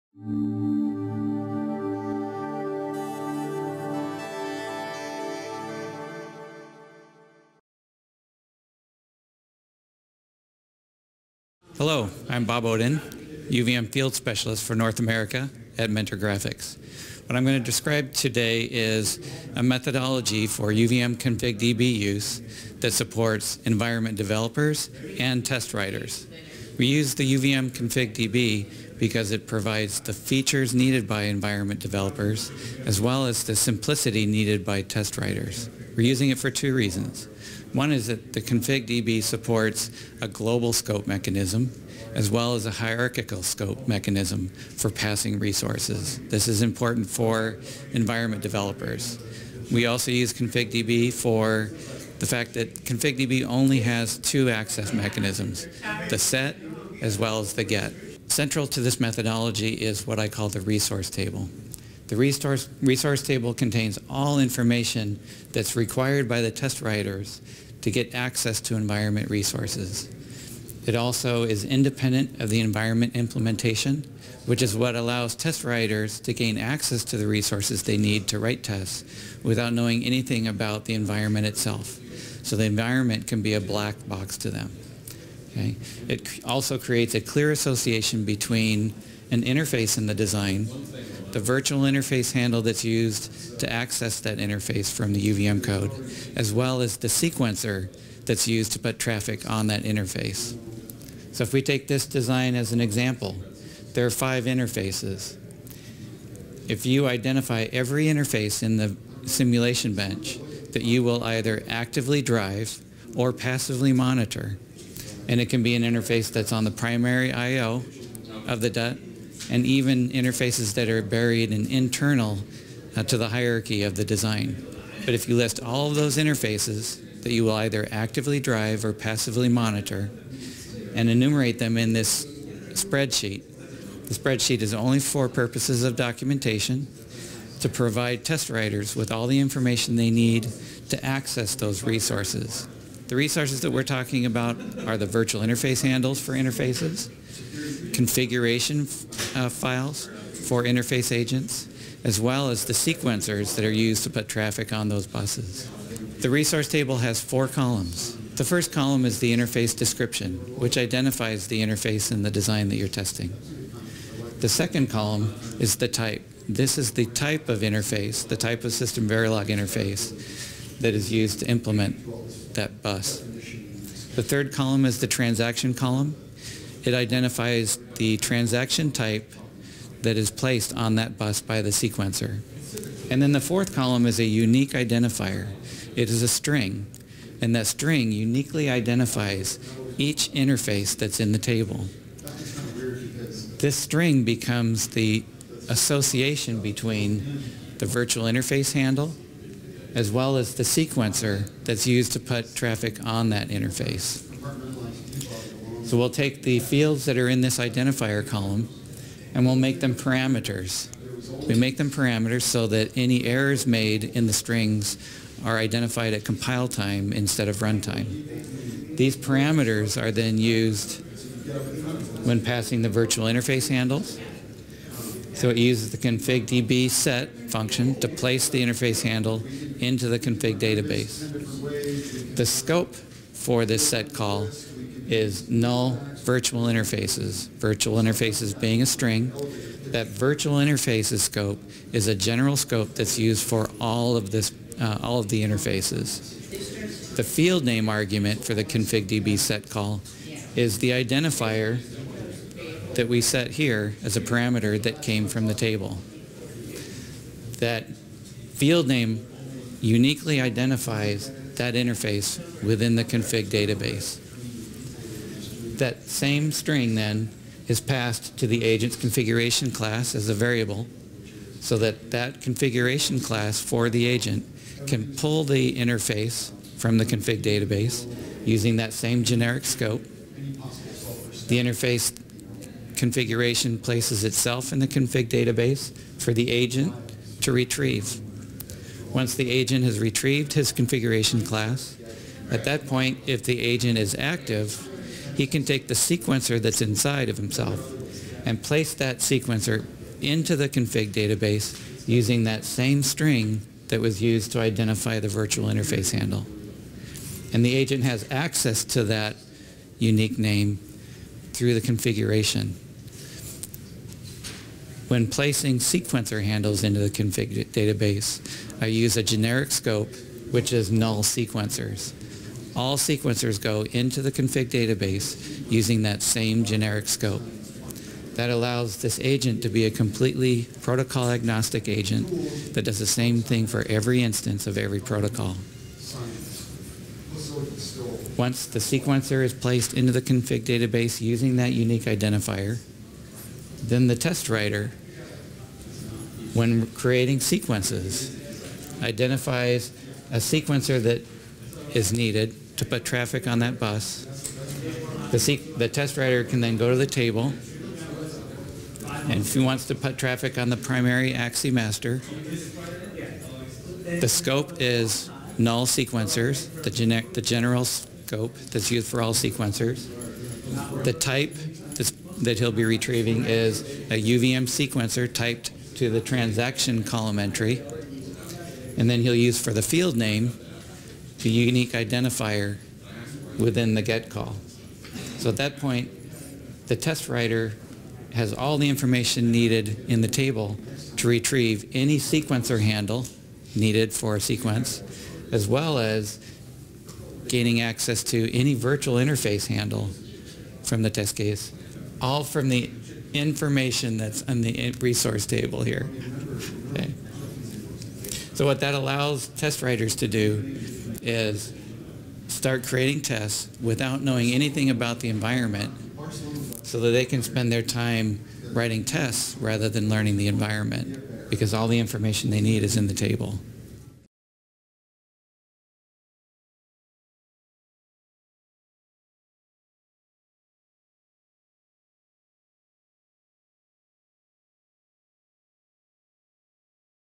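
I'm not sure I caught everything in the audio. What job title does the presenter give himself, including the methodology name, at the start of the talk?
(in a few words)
UVM Field Specialist.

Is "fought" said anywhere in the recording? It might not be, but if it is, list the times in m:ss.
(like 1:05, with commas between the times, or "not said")
not said.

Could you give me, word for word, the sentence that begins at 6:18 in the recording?
And then he'll use for the field name the unique identifier within the get call.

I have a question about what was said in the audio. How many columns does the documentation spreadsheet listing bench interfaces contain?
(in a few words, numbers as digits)
4.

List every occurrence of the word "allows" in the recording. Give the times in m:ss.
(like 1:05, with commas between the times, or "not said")
1:14, 5:28, 6:48.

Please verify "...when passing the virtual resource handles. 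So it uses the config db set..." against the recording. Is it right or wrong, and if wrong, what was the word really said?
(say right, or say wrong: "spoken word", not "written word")
wrong: "interface", not "resource".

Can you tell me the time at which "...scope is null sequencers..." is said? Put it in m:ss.
6:04.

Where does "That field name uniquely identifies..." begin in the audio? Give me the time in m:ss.
4:17.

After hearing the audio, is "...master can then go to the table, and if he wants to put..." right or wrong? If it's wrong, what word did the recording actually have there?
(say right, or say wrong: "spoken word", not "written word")
wrong: "writer", not "master".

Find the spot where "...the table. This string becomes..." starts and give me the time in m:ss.
3:11.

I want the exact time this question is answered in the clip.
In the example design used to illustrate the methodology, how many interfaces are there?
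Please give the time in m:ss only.
1:44.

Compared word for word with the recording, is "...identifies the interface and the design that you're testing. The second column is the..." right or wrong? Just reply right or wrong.
right.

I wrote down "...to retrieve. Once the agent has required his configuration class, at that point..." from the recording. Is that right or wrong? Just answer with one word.
wrong.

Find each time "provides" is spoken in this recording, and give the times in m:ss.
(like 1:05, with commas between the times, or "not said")
0:29, 2:17.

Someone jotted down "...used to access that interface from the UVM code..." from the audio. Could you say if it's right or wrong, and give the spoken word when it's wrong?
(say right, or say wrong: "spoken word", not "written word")
right.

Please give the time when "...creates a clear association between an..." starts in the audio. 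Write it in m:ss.
1:26.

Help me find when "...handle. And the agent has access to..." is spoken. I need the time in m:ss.
5:06.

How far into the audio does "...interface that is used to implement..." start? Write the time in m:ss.
2:49.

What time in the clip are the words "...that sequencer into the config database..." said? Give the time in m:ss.
4:58.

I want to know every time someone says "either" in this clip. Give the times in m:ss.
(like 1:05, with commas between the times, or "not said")
1:51, 2:07.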